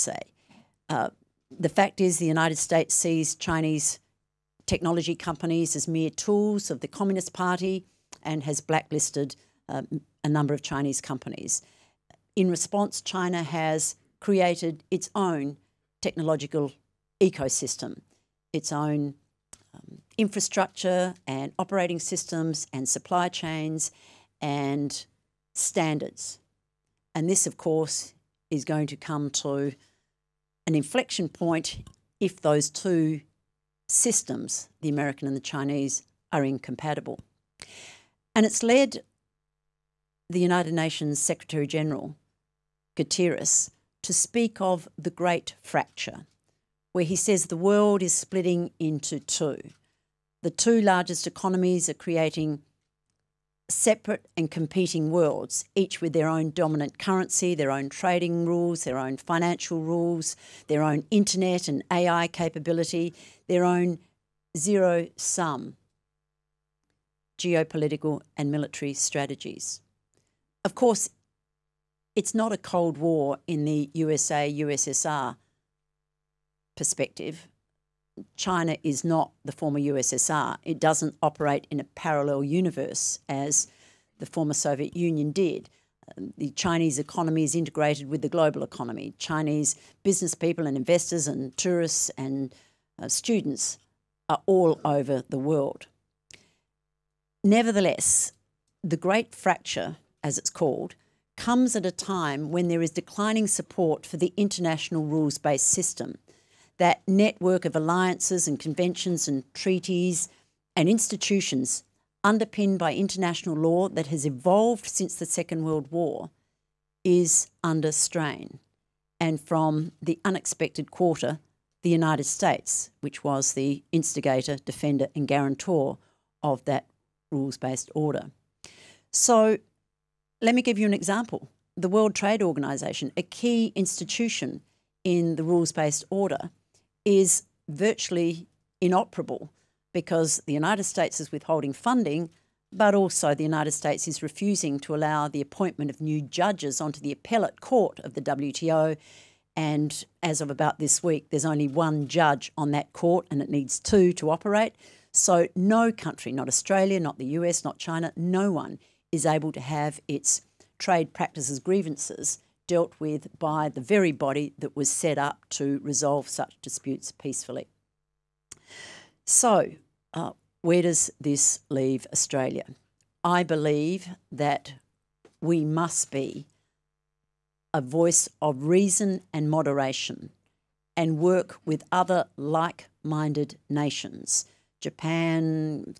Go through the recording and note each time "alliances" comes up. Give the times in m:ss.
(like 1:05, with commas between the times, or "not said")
1:47.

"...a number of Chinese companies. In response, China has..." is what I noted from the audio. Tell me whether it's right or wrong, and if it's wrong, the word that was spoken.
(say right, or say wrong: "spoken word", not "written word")
right.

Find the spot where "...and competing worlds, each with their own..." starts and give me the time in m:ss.
0:54.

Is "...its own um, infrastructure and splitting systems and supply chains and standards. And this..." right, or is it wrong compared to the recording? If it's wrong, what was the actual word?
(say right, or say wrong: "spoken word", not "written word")
wrong: "operating", not "splitting".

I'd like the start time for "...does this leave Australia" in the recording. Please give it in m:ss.
2:50.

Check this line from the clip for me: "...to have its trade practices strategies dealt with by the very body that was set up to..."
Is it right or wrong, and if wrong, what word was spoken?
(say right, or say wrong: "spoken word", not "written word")
wrong: "grievances", not "strategies".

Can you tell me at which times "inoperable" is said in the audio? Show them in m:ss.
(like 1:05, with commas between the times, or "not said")
2:18.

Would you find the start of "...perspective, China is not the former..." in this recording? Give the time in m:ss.
1:16.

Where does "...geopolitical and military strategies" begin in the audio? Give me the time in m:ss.
1:07.